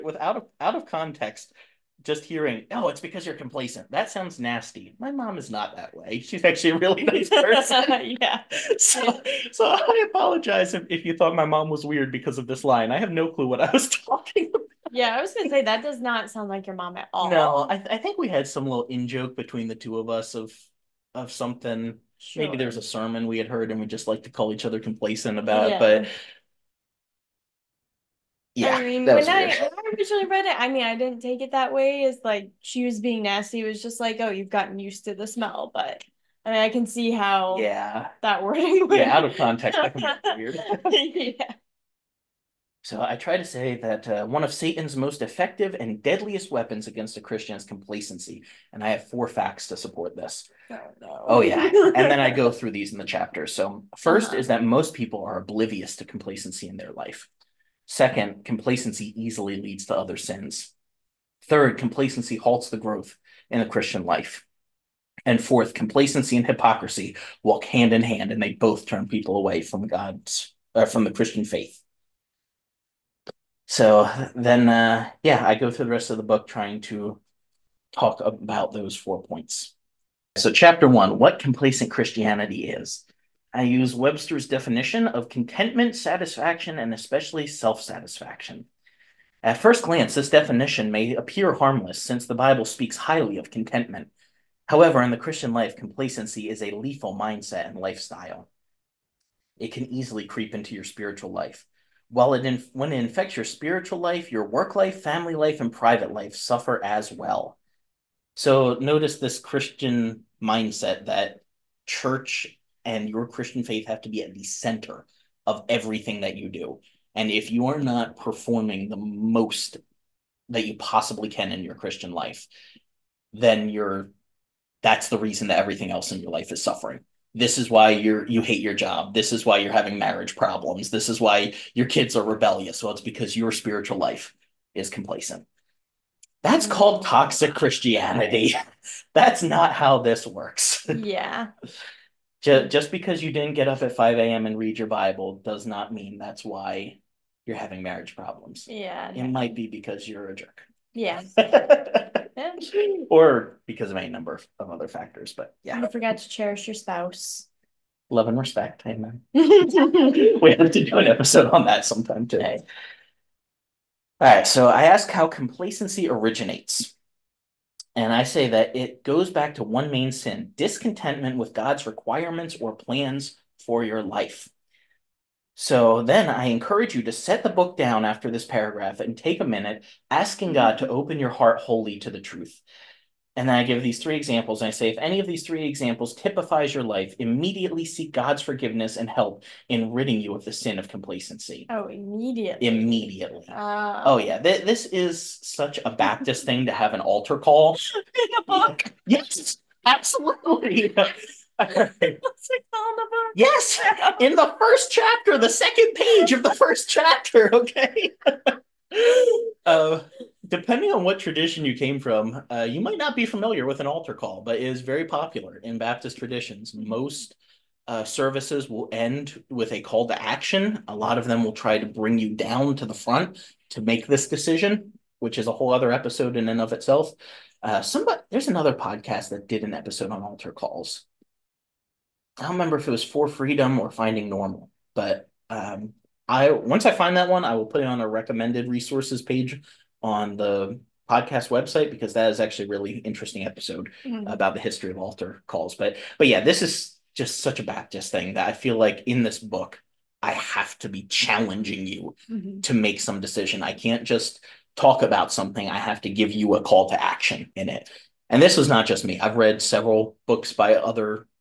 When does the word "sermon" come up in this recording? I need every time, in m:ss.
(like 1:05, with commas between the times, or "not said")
0:22.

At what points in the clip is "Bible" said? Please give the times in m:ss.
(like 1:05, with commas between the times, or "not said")
1:32, 2:24.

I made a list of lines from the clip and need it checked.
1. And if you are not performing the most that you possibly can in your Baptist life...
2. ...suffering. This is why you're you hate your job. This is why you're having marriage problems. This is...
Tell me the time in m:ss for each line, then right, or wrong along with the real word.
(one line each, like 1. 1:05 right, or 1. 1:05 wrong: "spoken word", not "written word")
1. 1:57 wrong: "Christian", not "Baptist"
2. 2:06 right.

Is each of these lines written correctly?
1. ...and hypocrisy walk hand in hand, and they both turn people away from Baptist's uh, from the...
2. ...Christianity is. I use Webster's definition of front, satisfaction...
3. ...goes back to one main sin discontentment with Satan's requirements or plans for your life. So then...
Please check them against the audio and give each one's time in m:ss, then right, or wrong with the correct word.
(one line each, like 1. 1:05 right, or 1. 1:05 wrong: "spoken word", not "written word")
1. 1:06 wrong: "God", not "Baptist"
2. 1:21 wrong: "contentment", not "front"
3. 2:49 wrong: "God", not "Satan".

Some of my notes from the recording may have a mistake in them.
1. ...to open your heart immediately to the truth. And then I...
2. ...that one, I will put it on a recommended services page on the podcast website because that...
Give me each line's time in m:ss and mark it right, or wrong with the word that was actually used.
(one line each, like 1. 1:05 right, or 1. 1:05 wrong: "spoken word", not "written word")
1. 3:00 wrong: "wholly", not "immediately"
2. 3:57 wrong: "resources", not "services".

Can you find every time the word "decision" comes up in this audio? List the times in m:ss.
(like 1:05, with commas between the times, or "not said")
3:44, 4:13.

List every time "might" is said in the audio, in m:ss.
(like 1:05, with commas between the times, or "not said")
2:29, 3:32.